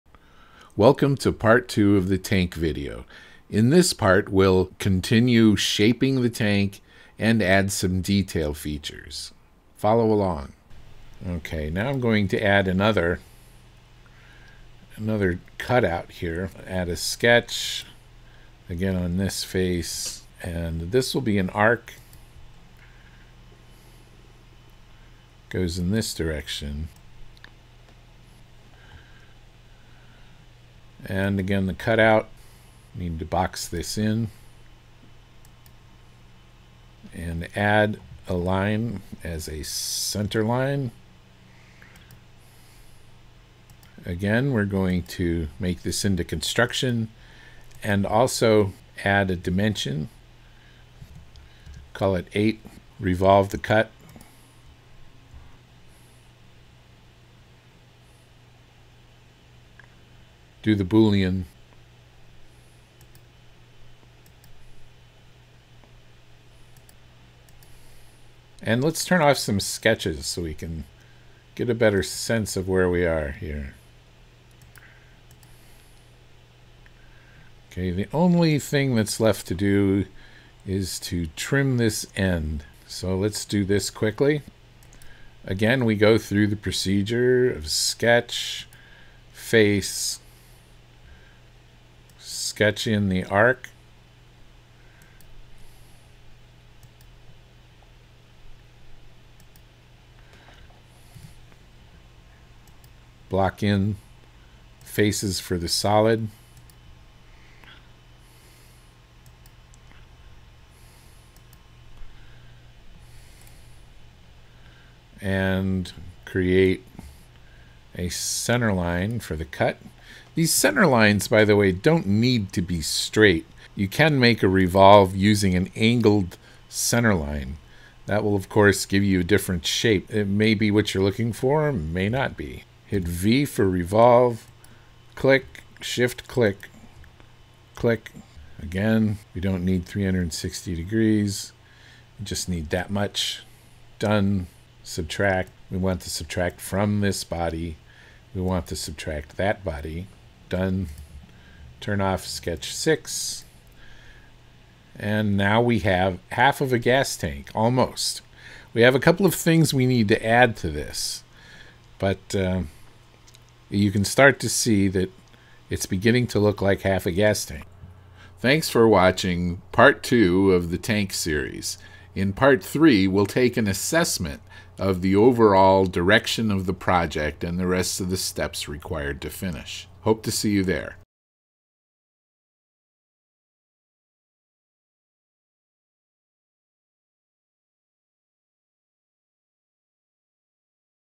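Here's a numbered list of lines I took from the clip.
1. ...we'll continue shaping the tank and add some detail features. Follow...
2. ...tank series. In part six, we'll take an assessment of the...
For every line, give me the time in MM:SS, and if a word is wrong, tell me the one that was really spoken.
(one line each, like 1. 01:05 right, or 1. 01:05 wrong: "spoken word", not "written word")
1. 00:04 right
2. 02:50 wrong: "three", not "six".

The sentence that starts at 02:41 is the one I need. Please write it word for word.
But uh, you can start to see that it's beginning to look like half a gas tank.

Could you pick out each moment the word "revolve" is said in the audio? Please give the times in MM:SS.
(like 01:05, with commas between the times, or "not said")
00:52, 02:04, 02:13.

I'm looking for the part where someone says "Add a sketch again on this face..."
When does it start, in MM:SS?
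00:16.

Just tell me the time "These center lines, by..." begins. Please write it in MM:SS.
02:00.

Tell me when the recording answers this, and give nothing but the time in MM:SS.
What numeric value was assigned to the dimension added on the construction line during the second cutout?
00:51.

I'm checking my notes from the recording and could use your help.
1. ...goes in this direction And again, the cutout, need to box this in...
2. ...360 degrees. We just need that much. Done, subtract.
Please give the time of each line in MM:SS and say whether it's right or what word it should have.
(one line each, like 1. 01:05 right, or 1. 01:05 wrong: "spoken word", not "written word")
1. 00:25 right
2. 02:19 right.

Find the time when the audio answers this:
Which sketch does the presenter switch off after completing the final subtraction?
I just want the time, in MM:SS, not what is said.
02:32.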